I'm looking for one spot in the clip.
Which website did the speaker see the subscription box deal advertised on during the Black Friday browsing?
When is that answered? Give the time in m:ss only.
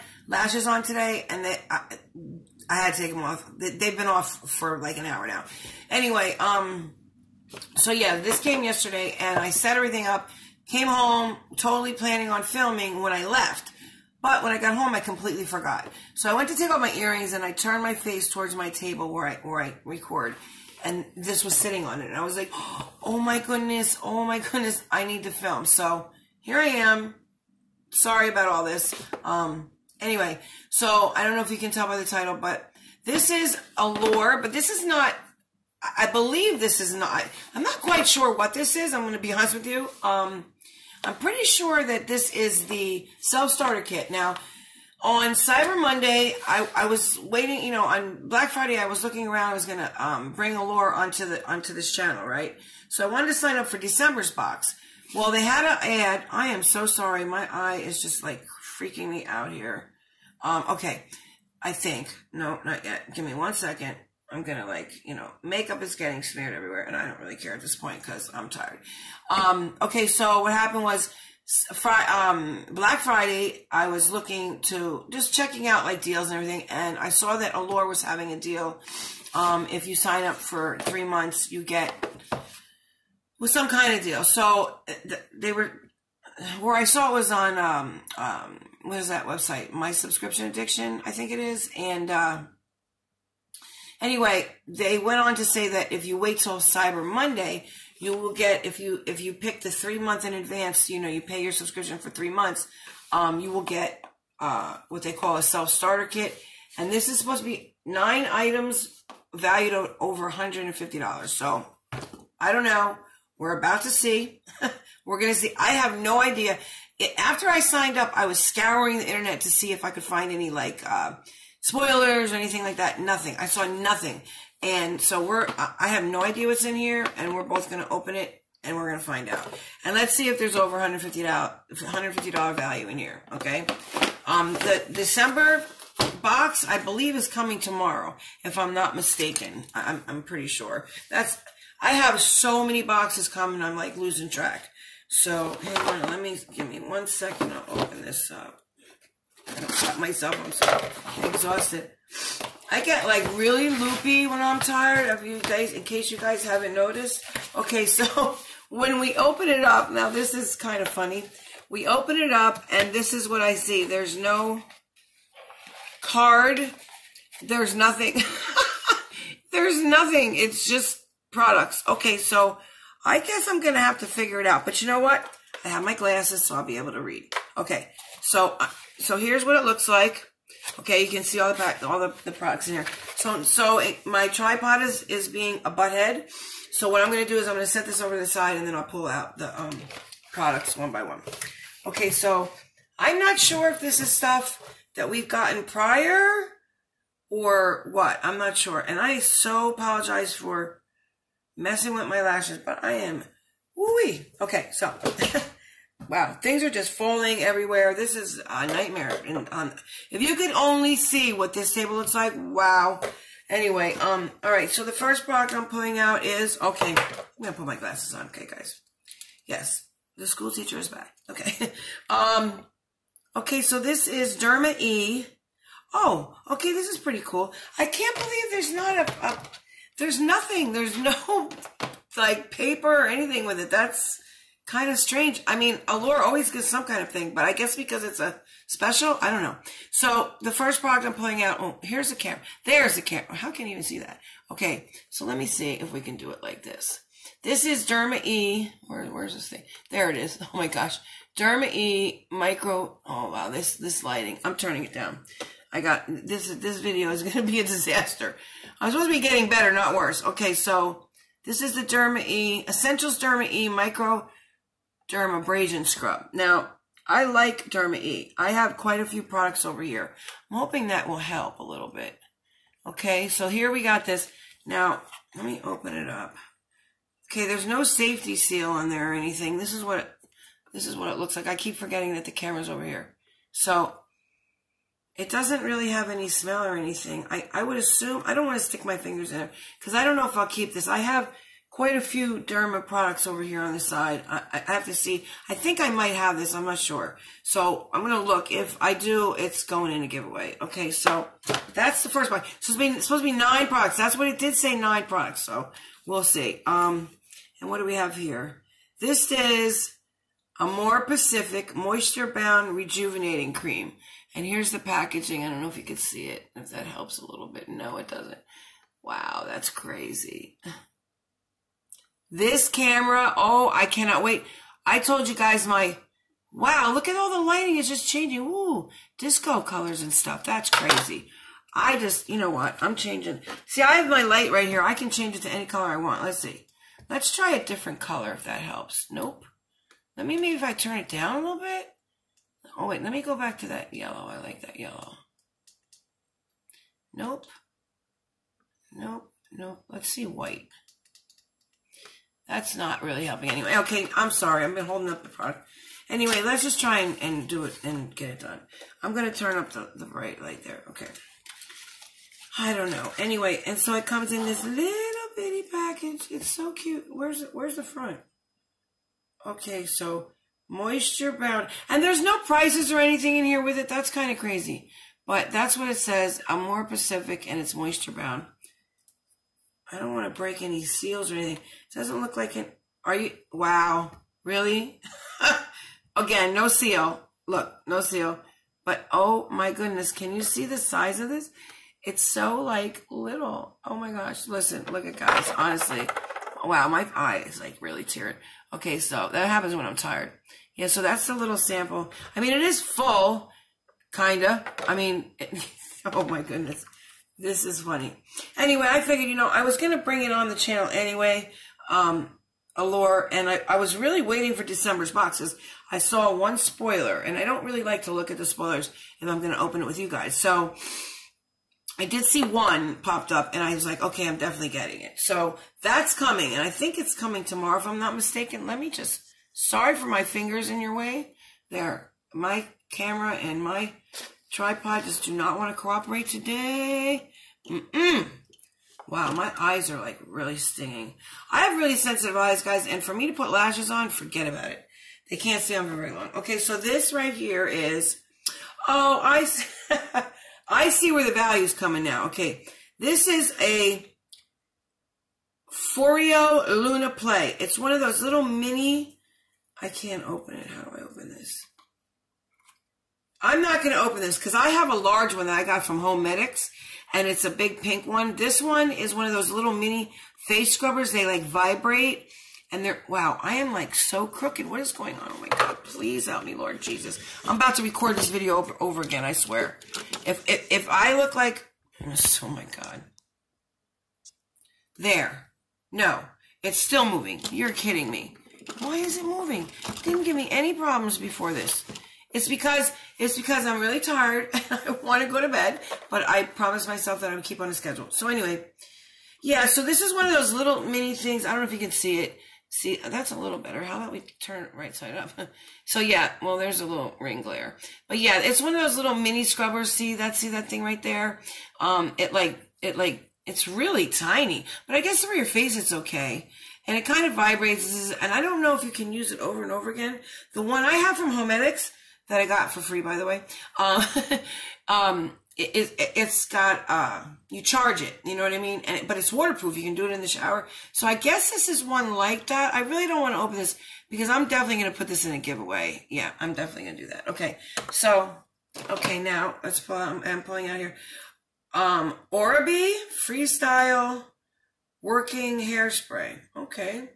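1:29.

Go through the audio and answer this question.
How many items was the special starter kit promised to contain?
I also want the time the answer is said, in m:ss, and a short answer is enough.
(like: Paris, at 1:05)
9, at 1:47.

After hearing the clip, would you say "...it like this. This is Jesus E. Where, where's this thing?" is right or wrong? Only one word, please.
wrong.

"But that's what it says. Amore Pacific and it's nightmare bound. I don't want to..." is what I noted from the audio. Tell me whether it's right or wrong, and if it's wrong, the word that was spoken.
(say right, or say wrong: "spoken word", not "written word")
wrong: "moisture", not "nightmare".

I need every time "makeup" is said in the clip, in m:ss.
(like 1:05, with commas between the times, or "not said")
1:05.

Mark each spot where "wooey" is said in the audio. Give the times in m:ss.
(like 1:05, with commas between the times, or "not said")
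3:23.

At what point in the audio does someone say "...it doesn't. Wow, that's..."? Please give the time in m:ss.
5:17.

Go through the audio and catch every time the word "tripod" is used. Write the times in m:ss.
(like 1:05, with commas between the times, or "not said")
3:04, 7:14.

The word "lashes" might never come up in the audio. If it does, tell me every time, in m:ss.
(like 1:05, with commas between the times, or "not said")
0:00, 3:22, 7:23.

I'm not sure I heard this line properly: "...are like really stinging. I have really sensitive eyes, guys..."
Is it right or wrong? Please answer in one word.
right.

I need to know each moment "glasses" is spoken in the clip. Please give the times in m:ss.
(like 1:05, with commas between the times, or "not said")
2:55, 3:37.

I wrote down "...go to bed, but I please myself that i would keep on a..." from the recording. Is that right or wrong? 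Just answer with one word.
wrong.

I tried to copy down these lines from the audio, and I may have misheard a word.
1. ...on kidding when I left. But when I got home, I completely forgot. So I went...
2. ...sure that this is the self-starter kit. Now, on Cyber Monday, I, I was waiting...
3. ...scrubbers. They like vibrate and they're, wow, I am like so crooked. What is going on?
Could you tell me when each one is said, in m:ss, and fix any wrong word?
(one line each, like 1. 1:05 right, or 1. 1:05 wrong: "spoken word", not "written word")
1. 0:12 wrong: "filming", not "kidding"
2. 0:41 right
3. 7:50 right.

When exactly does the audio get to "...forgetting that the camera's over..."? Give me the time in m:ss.
4:41.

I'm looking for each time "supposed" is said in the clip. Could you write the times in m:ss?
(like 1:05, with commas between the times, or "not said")
1:47, 4:18, 5:03.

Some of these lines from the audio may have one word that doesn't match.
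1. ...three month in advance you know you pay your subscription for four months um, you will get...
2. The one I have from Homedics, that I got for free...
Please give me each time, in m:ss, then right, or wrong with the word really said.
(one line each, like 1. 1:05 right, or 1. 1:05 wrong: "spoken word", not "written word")
1. 1:39 wrong: "three", not "four"
2. 8:40 right.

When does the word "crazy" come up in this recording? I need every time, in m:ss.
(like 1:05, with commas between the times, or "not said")
5:19, 5:30, 6:14.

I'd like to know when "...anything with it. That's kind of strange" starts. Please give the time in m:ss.
3:53.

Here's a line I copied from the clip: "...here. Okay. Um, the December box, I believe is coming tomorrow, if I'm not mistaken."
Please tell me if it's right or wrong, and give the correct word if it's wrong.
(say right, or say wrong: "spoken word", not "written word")
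right.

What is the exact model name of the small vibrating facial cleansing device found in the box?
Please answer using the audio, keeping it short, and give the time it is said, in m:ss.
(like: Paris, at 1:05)
Foreo Luna Play, at 7:35.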